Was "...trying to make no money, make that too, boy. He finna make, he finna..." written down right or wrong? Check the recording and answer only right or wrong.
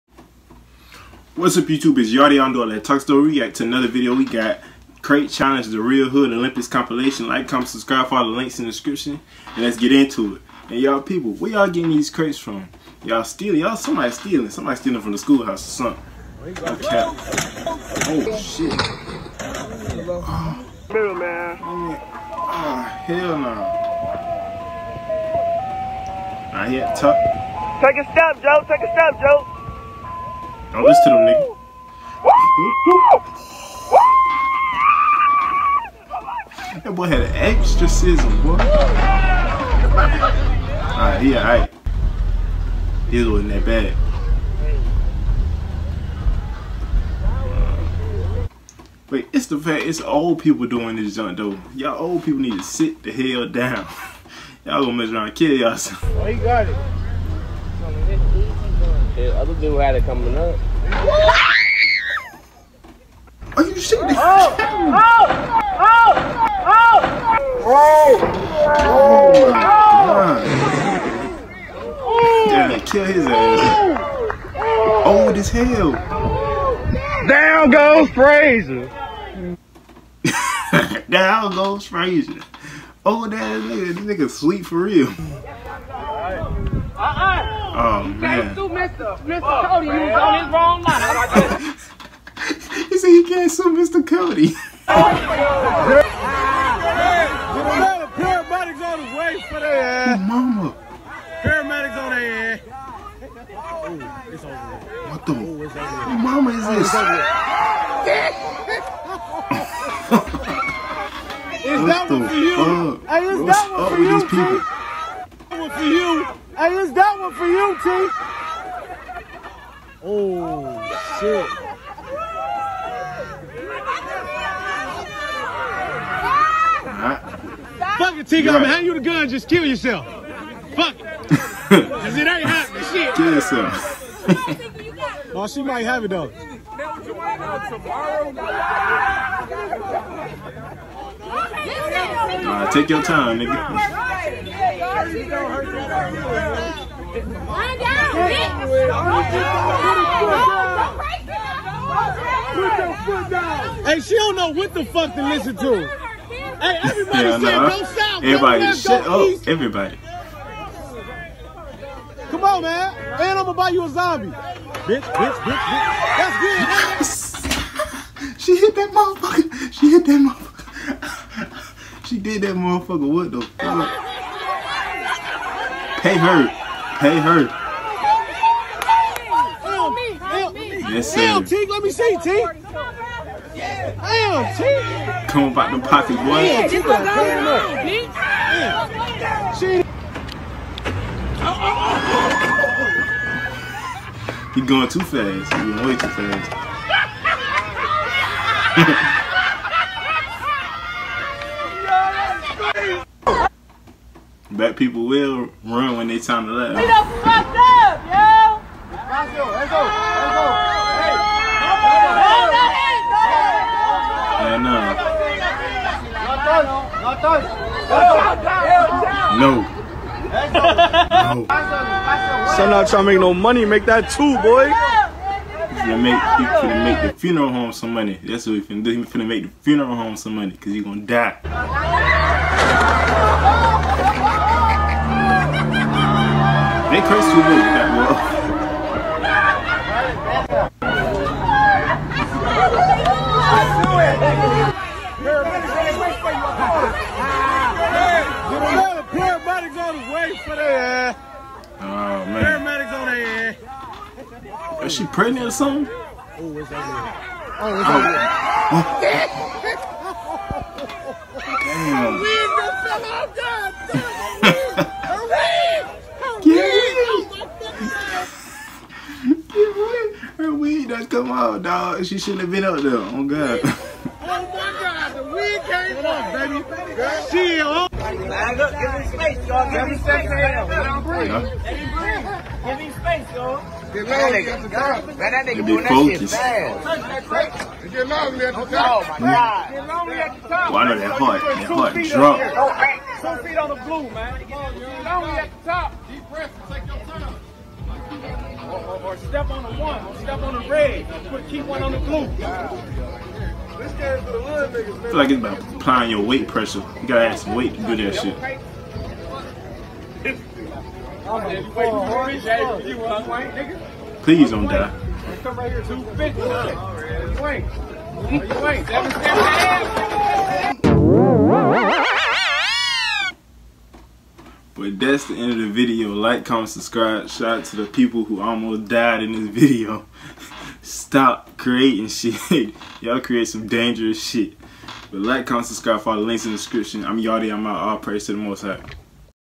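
right.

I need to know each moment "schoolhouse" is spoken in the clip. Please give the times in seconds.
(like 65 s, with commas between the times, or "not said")
15 s.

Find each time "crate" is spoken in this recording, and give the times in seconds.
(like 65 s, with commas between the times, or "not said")
5 s, 12 s.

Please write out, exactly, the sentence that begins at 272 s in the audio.
She shouldn't have been up there.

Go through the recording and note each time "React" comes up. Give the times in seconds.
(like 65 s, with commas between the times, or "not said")
3 s.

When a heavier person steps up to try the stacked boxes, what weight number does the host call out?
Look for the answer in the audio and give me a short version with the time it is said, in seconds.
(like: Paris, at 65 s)
250, at 315 s.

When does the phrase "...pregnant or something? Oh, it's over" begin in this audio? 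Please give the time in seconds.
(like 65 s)
255 s.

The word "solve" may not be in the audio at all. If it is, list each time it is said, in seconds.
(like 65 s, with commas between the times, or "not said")
not said.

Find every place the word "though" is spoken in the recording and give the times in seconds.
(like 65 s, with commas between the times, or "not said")
51 s, 136 s.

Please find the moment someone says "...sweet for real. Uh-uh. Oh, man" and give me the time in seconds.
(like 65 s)
84 s.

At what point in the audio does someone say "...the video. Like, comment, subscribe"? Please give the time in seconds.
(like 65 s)
325 s.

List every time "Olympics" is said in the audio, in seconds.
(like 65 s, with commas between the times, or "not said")
6 s.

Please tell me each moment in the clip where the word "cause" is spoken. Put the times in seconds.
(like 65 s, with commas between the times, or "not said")
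131 s, 230 s.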